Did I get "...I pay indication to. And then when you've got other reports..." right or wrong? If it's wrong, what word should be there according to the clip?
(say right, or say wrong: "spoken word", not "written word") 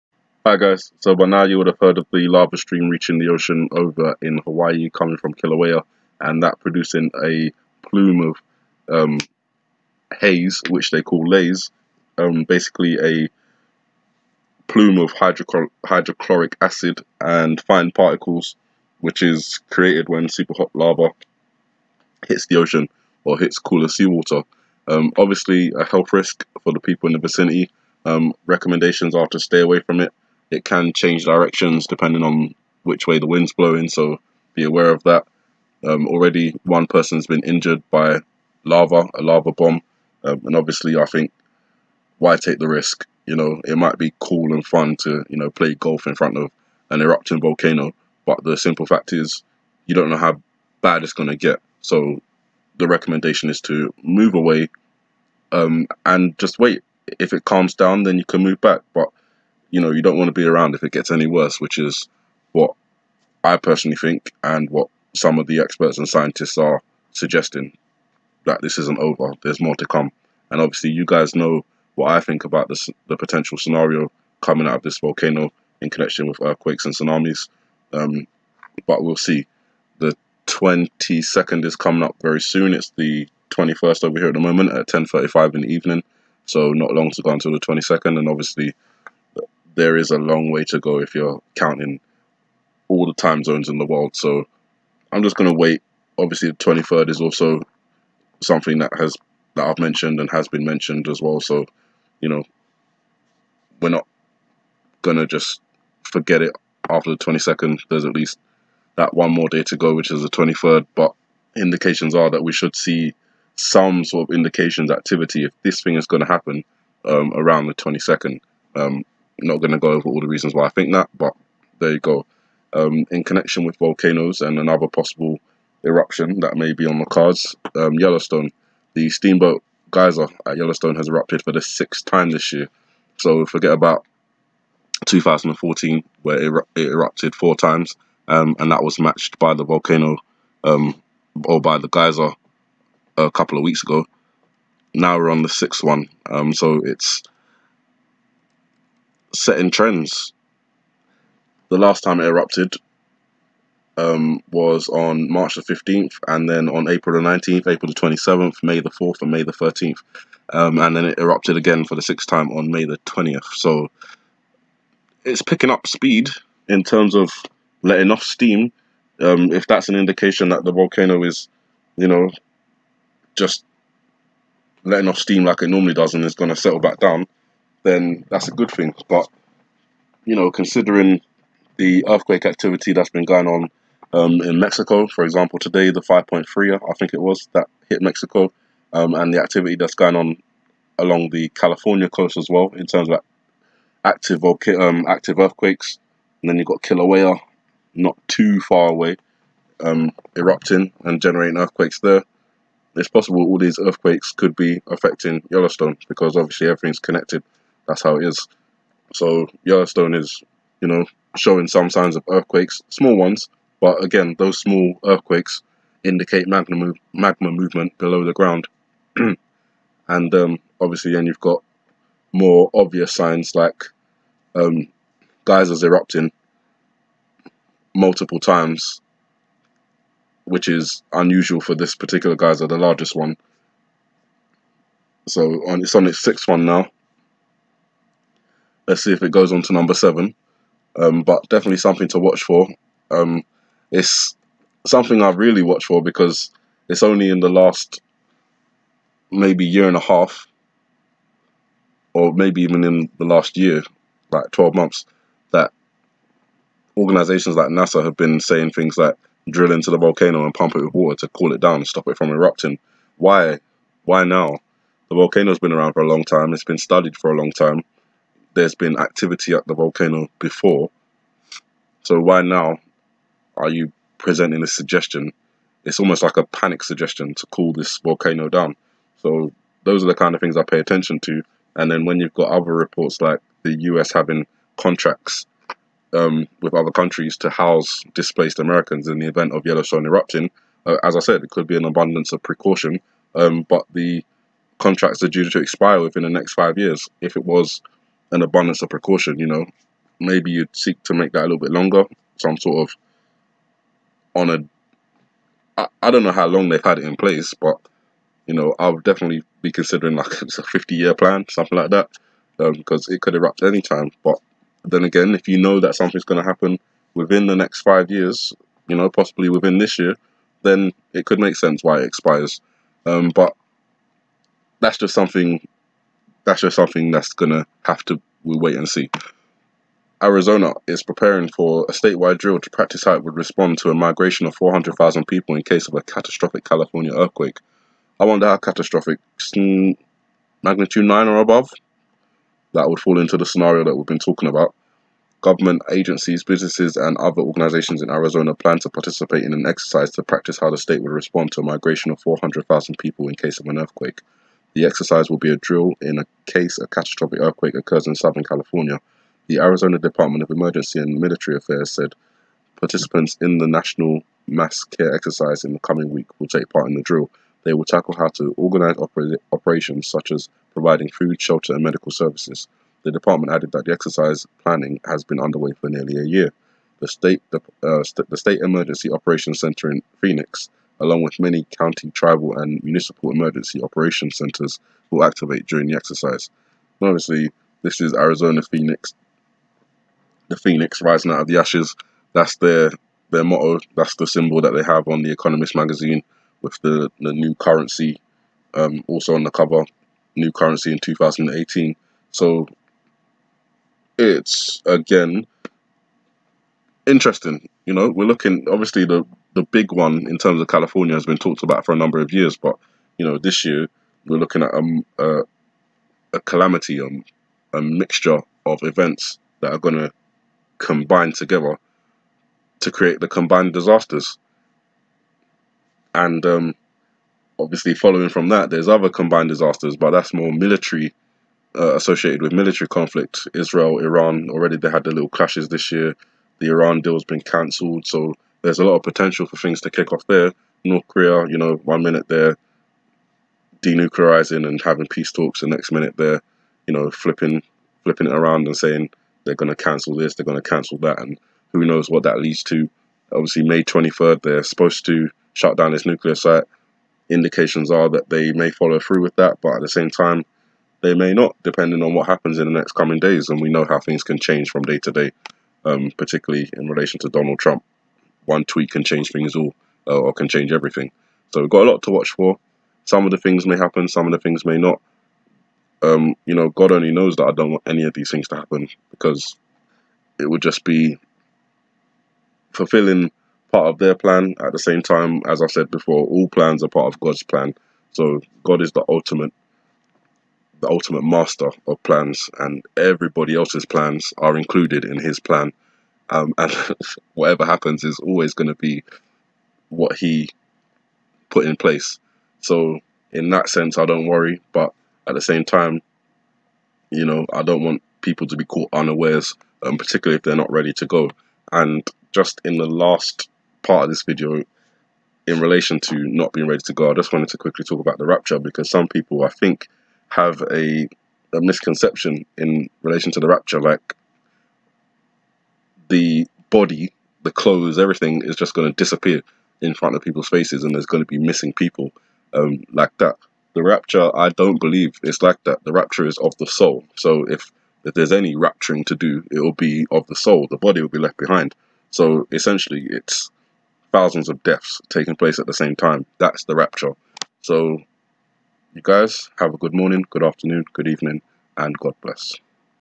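wrong: "attention", not "indication".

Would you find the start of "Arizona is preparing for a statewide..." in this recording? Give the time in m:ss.
5:30.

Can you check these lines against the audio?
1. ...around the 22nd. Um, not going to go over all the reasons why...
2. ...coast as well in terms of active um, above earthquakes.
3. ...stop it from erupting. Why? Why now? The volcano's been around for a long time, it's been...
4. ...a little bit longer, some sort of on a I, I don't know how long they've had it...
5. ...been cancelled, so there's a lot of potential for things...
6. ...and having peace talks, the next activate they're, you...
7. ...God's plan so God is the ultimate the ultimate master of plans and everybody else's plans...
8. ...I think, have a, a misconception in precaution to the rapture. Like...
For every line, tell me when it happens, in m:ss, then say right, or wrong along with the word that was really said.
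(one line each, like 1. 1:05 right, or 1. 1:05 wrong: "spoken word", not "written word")
1. 1:57 right
2. 3:12 wrong: "active", not "above"
3. 4:21 right
4. 5:01 right
5. 7:17 right
6. 7:24 wrong: "minute", not "activate"
7. 8:07 right
8. 8:39 wrong: "relation", not "precaution".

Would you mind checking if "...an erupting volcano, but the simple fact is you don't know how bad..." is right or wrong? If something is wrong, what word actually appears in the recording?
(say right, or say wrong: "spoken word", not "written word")
right.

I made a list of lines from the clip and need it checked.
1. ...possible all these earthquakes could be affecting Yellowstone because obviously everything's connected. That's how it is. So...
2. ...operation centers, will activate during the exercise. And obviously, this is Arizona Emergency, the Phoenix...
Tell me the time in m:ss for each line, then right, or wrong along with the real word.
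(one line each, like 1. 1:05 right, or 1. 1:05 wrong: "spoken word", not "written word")
1. 3:23 right
2. 6:23 wrong: "Phoenix", not "Emergency".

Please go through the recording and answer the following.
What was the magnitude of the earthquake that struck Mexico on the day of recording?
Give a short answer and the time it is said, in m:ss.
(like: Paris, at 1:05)
5.3, at 3:06.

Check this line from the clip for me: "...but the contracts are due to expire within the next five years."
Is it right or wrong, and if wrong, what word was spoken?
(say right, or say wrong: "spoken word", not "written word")
right.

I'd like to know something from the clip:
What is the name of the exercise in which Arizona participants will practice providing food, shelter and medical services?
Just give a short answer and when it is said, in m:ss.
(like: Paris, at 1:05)
National Mass Care Exercise, at 6:03.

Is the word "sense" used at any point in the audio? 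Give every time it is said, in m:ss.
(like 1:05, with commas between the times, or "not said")
5:21, 8:23.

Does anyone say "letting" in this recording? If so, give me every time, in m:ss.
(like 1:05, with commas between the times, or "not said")
2:47, 2:54.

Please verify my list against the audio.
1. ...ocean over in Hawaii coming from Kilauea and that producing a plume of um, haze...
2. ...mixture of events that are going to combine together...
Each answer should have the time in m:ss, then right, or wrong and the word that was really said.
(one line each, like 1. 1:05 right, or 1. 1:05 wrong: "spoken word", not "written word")
1. 0:03 right
2. 6:57 right.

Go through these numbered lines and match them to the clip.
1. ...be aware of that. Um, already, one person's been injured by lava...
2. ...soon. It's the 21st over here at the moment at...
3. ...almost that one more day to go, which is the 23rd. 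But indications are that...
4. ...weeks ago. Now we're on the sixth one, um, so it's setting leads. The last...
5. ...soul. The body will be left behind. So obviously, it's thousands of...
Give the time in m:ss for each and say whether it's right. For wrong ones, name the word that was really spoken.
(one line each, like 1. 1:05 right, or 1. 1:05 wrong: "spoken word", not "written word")
1. 0:34 right
2. 1:22 right
3. 1:48 wrong: "least", not "almost"
4. 2:23 wrong: "trends", not "leads"
5. 9:00 wrong: "essentially", not "obviously".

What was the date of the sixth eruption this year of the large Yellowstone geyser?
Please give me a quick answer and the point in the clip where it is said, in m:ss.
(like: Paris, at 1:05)
May 20th, at 2:42.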